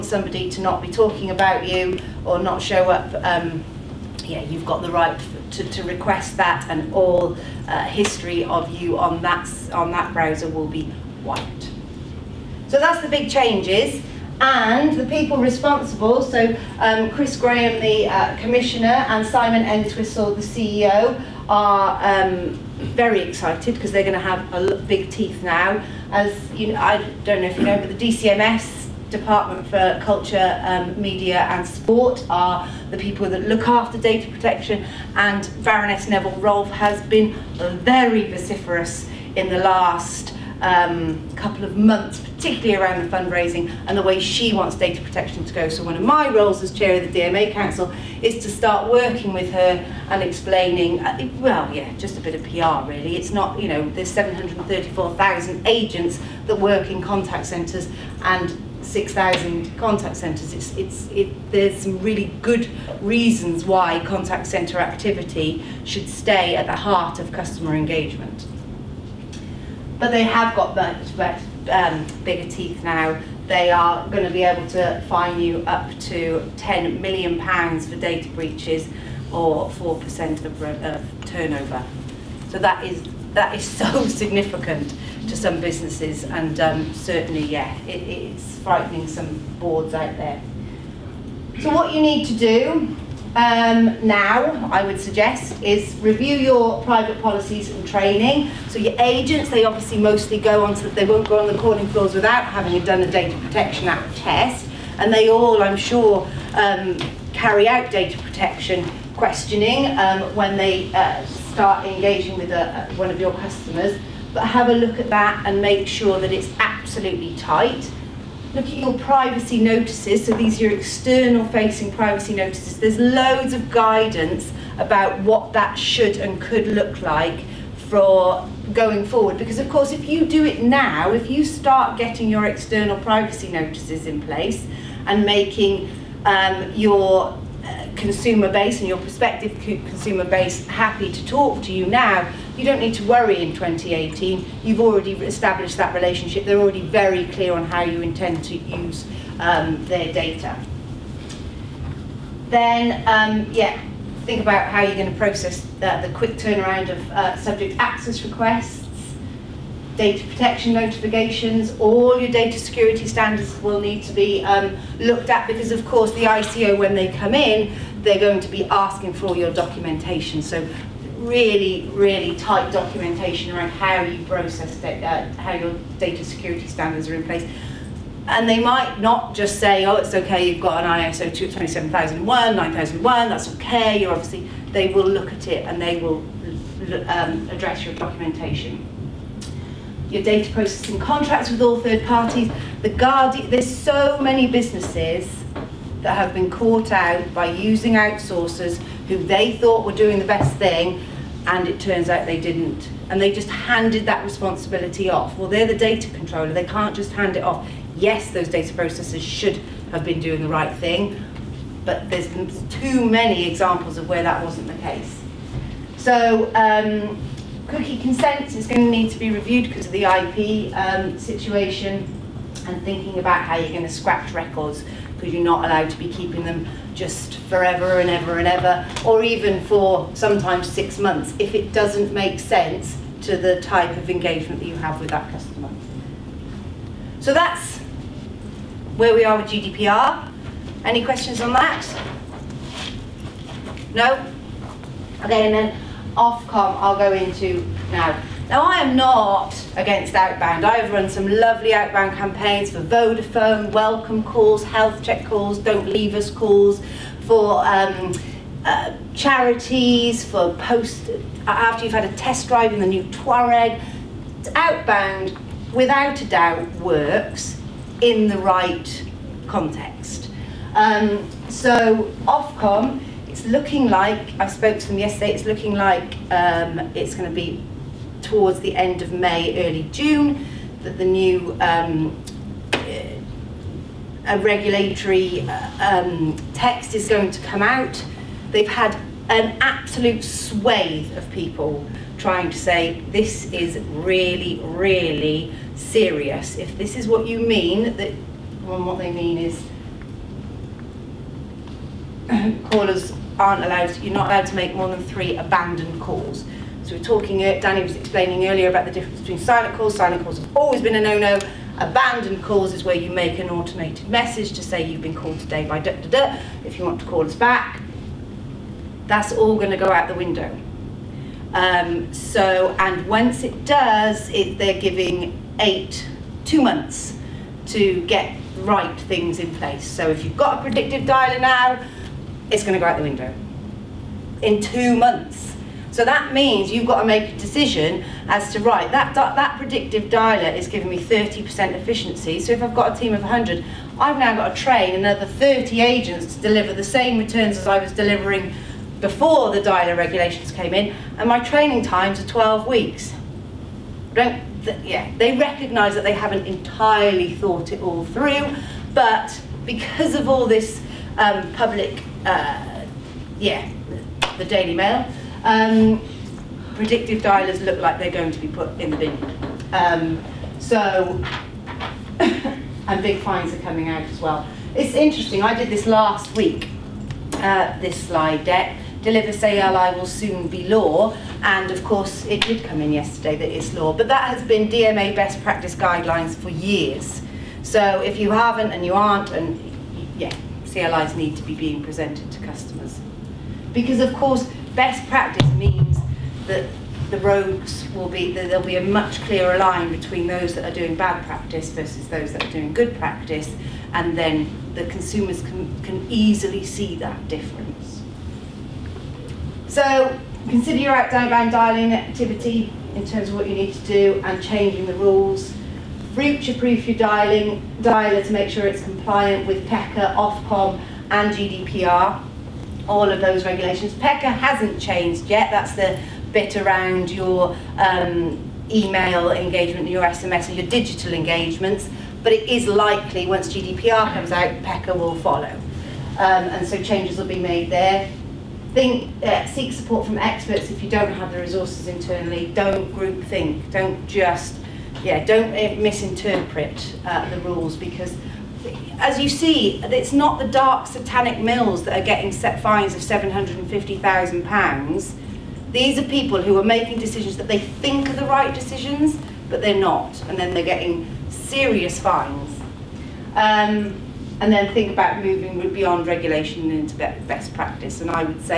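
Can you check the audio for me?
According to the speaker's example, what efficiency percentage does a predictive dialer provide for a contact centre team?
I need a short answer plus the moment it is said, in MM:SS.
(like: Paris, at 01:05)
30%, at 05:40.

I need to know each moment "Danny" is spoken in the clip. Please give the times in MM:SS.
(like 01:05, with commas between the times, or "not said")
05:07.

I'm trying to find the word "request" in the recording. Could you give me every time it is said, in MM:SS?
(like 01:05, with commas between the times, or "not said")
00:05, 02:38.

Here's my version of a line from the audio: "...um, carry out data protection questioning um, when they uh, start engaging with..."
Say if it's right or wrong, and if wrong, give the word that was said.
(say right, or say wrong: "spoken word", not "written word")
right.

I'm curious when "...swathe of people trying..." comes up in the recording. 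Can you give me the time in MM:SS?
04:50.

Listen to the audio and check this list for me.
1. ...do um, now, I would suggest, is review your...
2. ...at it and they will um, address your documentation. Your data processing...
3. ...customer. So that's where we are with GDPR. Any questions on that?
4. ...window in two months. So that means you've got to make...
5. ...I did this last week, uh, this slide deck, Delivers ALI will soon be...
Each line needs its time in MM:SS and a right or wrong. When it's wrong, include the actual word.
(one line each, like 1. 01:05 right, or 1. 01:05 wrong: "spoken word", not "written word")
1. 01:32 right
2. 03:05 right
3. 03:55 right
4. 05:33 right
5. 06:15 right.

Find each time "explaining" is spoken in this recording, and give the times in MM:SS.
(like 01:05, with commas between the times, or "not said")
00:50, 05:07.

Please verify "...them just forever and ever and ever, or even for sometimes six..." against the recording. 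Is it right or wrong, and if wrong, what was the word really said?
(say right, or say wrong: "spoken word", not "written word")
right.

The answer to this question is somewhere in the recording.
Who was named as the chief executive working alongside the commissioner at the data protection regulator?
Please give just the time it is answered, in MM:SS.
00:19.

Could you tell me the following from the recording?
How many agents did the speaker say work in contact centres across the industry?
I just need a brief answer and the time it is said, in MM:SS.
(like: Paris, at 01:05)
734,000, at 00:54.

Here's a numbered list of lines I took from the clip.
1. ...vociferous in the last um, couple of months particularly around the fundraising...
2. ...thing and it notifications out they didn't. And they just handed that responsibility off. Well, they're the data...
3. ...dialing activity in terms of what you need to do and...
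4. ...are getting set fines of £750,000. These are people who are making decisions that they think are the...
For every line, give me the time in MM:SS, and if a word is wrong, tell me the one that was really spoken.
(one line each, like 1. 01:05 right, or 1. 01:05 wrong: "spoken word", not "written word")
1. 00:38 right
2. 03:20 wrong: "turns", not "notifications"
3. 06:51 right
4. 07:31 right.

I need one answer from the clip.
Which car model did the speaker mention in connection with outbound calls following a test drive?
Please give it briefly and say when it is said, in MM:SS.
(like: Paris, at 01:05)
Touareg, at 04:23.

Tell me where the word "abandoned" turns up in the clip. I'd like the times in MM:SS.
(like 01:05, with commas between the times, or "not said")
05:05, 05:11.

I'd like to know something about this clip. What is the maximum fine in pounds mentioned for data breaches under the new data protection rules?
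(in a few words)
£10 million.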